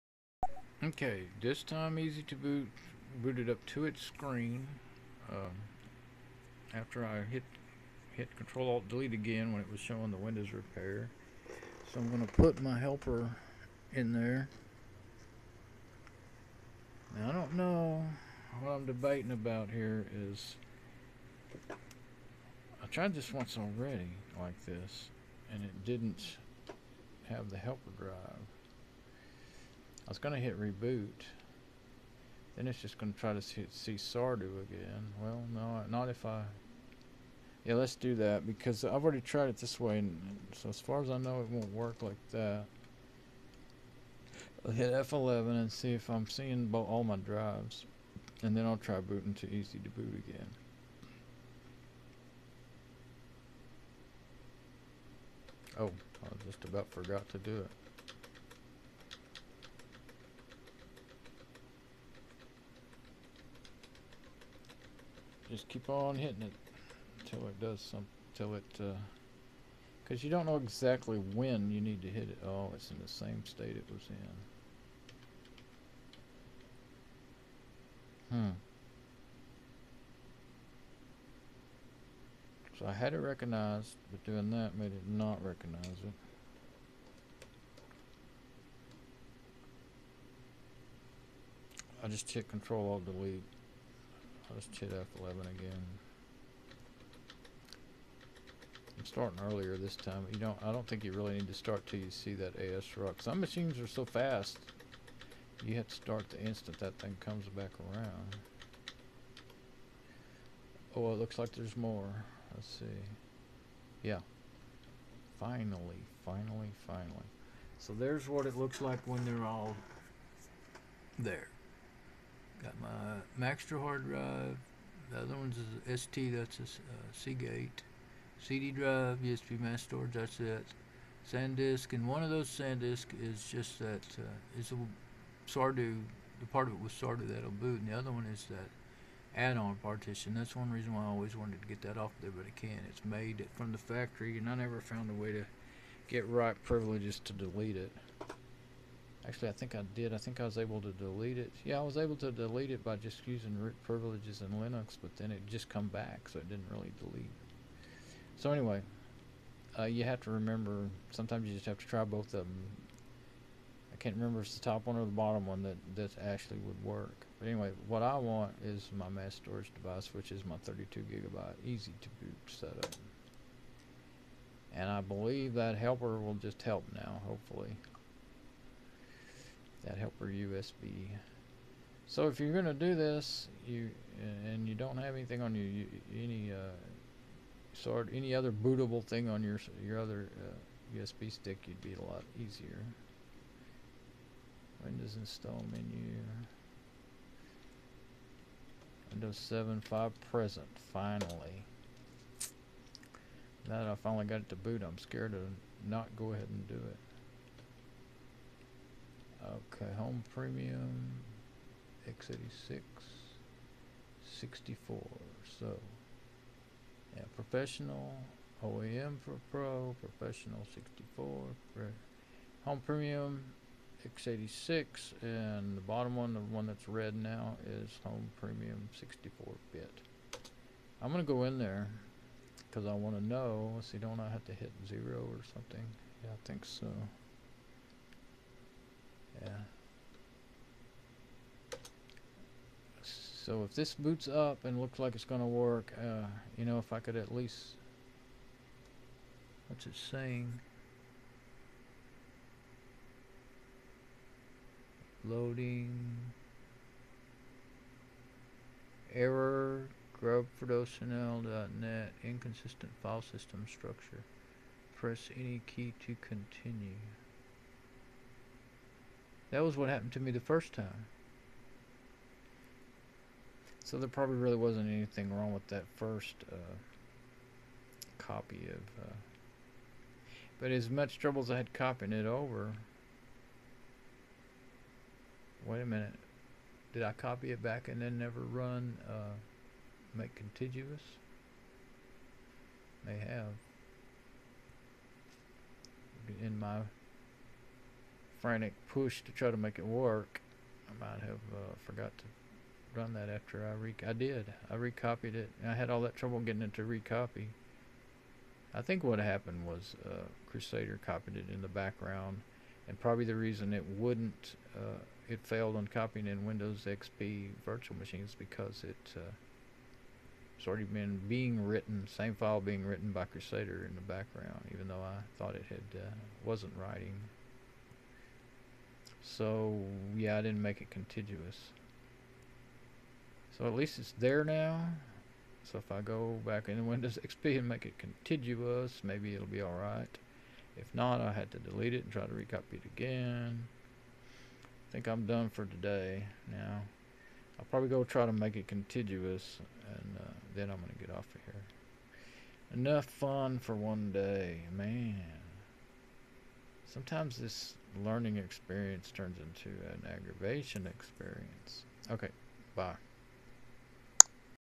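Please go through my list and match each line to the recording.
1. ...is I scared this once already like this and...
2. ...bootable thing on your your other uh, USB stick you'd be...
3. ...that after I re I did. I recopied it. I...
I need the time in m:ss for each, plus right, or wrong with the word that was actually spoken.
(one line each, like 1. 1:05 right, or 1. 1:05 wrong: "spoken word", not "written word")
1. 0:20 wrong: "tried", not "scared"
2. 3:08 right
3. 5:03 right.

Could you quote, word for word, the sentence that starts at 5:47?
I'll probably go try to make it contiguous, and uh, then I'm going to get off of here.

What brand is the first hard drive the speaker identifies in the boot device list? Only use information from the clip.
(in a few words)
Maxtor.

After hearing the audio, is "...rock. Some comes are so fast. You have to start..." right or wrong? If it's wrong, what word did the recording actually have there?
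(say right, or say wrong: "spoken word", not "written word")
wrong: "machines", not "comes".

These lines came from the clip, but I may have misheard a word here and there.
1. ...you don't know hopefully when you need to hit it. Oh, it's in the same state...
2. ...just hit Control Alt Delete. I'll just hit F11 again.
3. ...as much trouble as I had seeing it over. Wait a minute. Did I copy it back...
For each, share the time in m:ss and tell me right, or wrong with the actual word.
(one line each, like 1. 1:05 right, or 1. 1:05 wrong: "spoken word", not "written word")
1. 1:10 wrong: "exactly", not "hopefully"
2. 1:32 right
3. 4:40 wrong: "copying", not "seeing".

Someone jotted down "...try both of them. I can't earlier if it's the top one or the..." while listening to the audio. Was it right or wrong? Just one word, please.
wrong.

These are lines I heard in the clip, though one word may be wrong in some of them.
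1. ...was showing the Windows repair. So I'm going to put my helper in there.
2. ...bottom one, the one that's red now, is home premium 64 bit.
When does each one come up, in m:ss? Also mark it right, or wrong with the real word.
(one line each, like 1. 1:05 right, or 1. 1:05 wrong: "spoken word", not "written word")
1. 0:09 right
2. 3:45 right.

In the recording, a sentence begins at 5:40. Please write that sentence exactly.
If not, I had to delete it and try to recopy it again.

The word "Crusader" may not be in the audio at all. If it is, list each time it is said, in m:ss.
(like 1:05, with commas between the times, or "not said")
5:10, 5:23.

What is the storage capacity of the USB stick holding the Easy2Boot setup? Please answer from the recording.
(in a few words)
32 gigabytes.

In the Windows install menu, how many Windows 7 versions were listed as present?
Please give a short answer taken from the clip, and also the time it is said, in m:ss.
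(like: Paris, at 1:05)
5, at 3:19.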